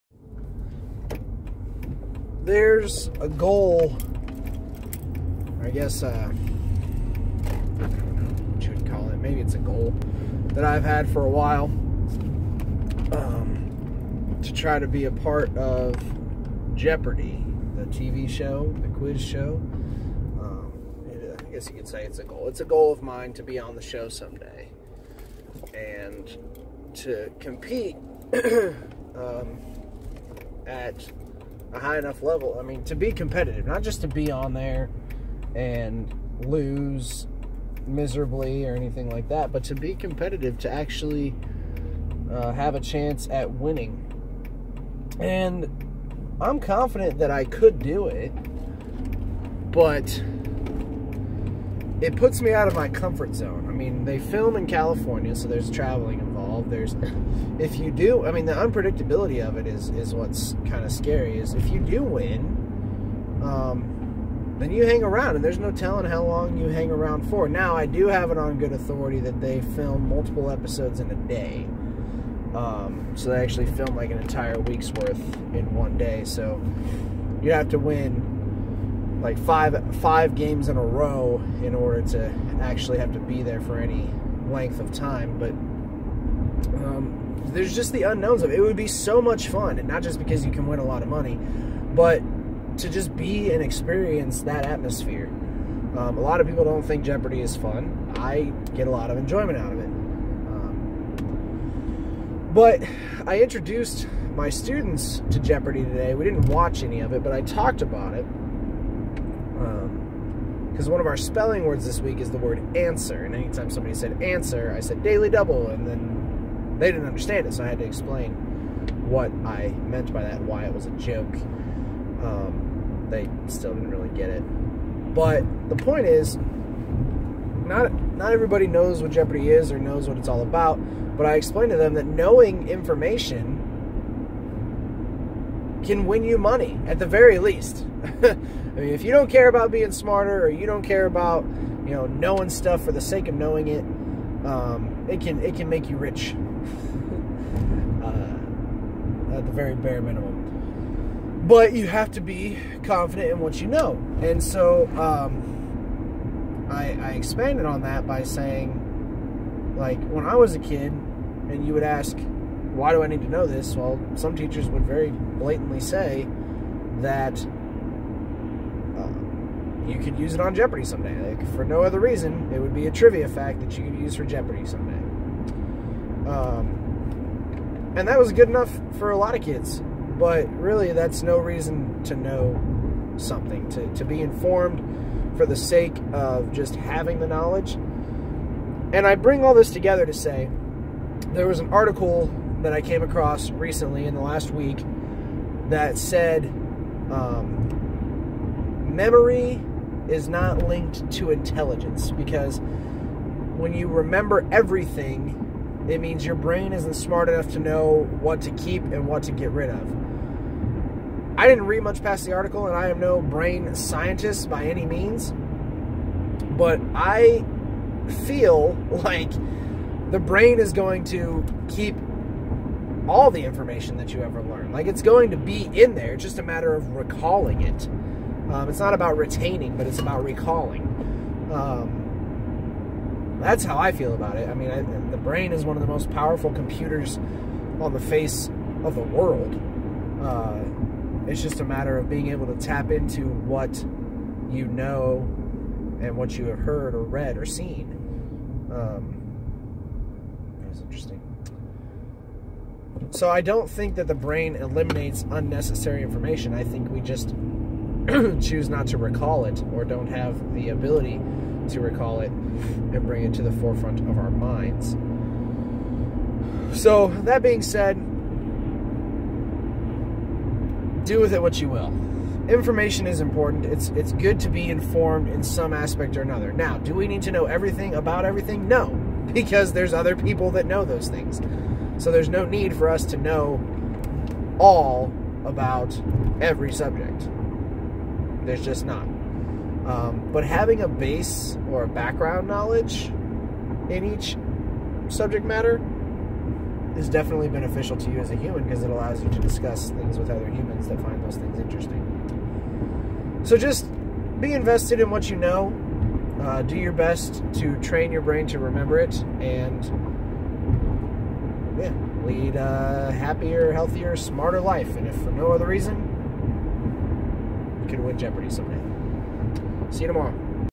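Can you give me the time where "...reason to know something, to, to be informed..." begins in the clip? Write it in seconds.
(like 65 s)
181 s.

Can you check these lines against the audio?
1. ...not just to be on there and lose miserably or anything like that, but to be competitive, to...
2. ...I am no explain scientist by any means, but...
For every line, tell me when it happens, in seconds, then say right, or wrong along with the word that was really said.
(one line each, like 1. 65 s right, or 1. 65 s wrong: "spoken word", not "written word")
1. 33 s right
2. 212 s wrong: "brain", not "explain".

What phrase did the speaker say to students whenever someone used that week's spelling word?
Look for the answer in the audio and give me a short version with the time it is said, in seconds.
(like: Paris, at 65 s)
daily double, at 115 s.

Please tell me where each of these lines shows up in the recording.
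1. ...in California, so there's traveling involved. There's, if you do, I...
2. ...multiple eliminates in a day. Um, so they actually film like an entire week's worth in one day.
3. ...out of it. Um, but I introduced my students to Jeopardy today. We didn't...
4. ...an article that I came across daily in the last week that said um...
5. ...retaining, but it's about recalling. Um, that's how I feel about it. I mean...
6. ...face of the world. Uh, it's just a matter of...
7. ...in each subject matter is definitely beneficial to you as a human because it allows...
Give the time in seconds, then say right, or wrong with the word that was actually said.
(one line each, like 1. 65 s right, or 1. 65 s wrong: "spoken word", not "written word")
1. 54 s right
2. 70 s wrong: "episodes", not "eliminates"
3. 99 s right
4. 191 s wrong: "recently", not "daily"
5. 229 s right
6. 237 s right
7. 293 s right.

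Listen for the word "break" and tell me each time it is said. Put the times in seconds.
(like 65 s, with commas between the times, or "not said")
not said.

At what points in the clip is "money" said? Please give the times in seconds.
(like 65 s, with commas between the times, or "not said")
91 s, 136 s.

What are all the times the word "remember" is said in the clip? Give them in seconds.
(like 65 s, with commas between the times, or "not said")
203 s, 308 s.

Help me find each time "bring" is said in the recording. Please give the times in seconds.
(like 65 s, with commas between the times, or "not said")
189 s, 263 s.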